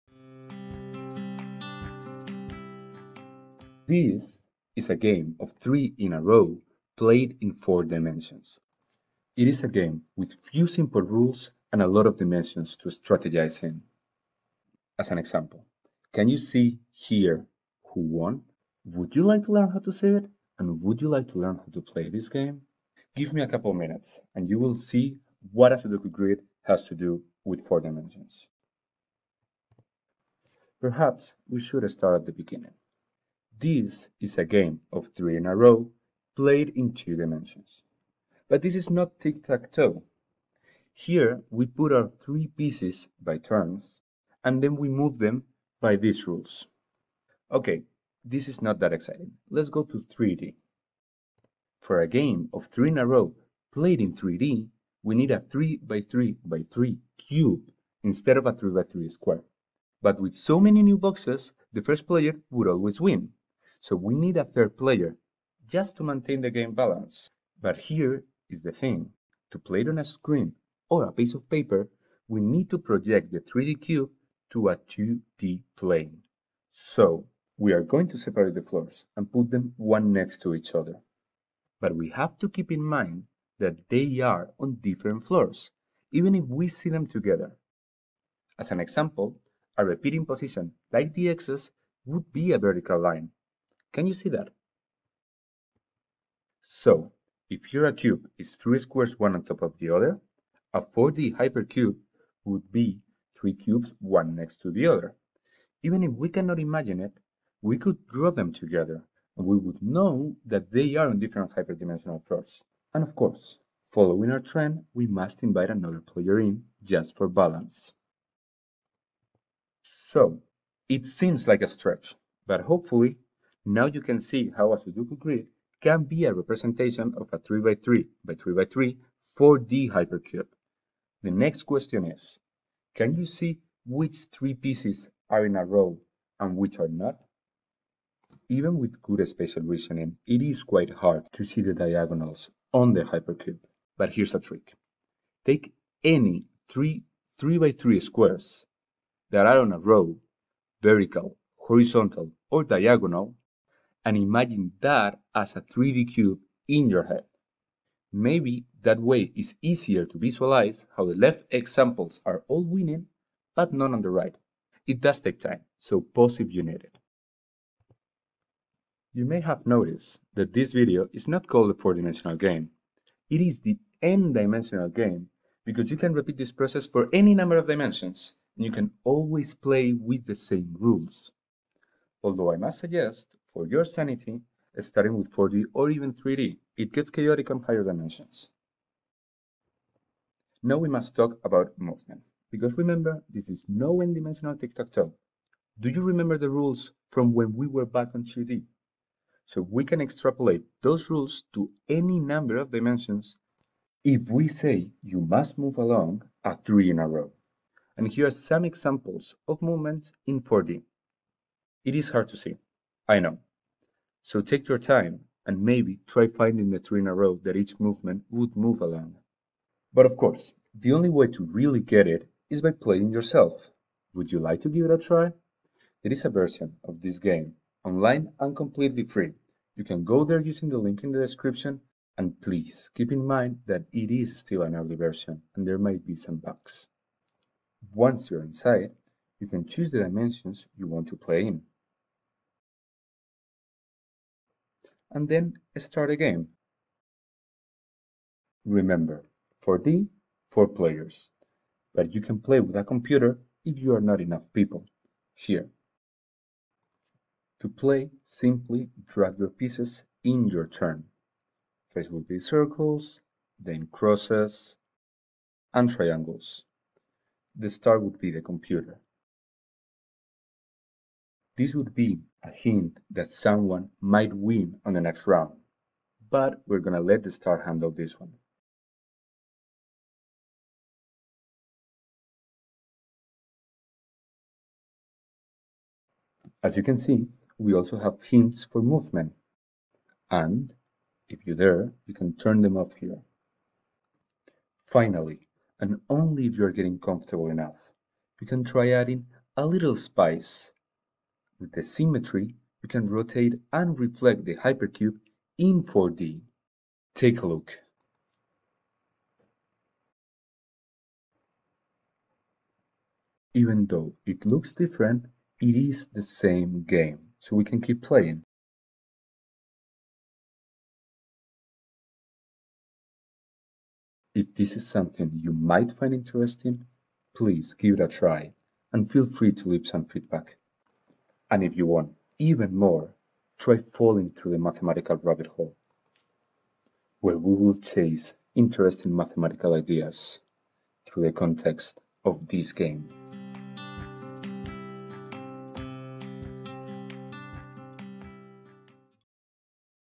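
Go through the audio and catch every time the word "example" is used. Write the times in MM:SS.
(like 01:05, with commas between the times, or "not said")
00:15, 01:28, 02:41, 03:28.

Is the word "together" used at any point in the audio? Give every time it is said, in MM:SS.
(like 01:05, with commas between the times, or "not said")
01:27, 01:48.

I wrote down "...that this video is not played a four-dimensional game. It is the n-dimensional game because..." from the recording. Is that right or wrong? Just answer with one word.
wrong.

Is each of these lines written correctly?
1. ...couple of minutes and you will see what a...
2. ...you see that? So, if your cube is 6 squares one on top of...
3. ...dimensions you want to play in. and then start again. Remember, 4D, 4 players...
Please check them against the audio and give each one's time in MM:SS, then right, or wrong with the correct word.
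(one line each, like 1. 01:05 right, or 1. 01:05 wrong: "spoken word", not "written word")
1. 00:23 right
2. 01:34 wrong: "3", not "6"
3. 04:00 right.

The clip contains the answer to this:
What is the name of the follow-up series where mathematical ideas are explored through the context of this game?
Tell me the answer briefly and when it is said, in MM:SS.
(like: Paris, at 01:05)
The mathematical rabbit hole, at 05:34.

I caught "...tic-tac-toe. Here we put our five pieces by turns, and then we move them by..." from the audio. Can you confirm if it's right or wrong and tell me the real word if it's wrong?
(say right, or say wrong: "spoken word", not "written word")
wrong: "three", not "five".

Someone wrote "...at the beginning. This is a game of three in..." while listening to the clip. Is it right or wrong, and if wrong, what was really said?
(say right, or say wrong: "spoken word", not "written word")
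right.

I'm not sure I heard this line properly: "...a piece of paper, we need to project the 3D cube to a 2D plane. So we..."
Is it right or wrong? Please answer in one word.
right.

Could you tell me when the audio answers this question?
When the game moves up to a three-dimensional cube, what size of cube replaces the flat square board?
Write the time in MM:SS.
00:55.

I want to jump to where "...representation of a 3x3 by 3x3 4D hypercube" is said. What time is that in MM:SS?
02:06.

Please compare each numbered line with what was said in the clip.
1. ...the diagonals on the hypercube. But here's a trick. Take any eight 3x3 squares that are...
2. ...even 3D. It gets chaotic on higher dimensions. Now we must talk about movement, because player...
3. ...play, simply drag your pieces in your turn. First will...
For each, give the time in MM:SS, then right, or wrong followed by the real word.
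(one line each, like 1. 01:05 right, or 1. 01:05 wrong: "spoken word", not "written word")
1. 02:21 wrong: "three", not "eight"
2. 03:05 wrong: "remember", not "player"
3. 04:17 right.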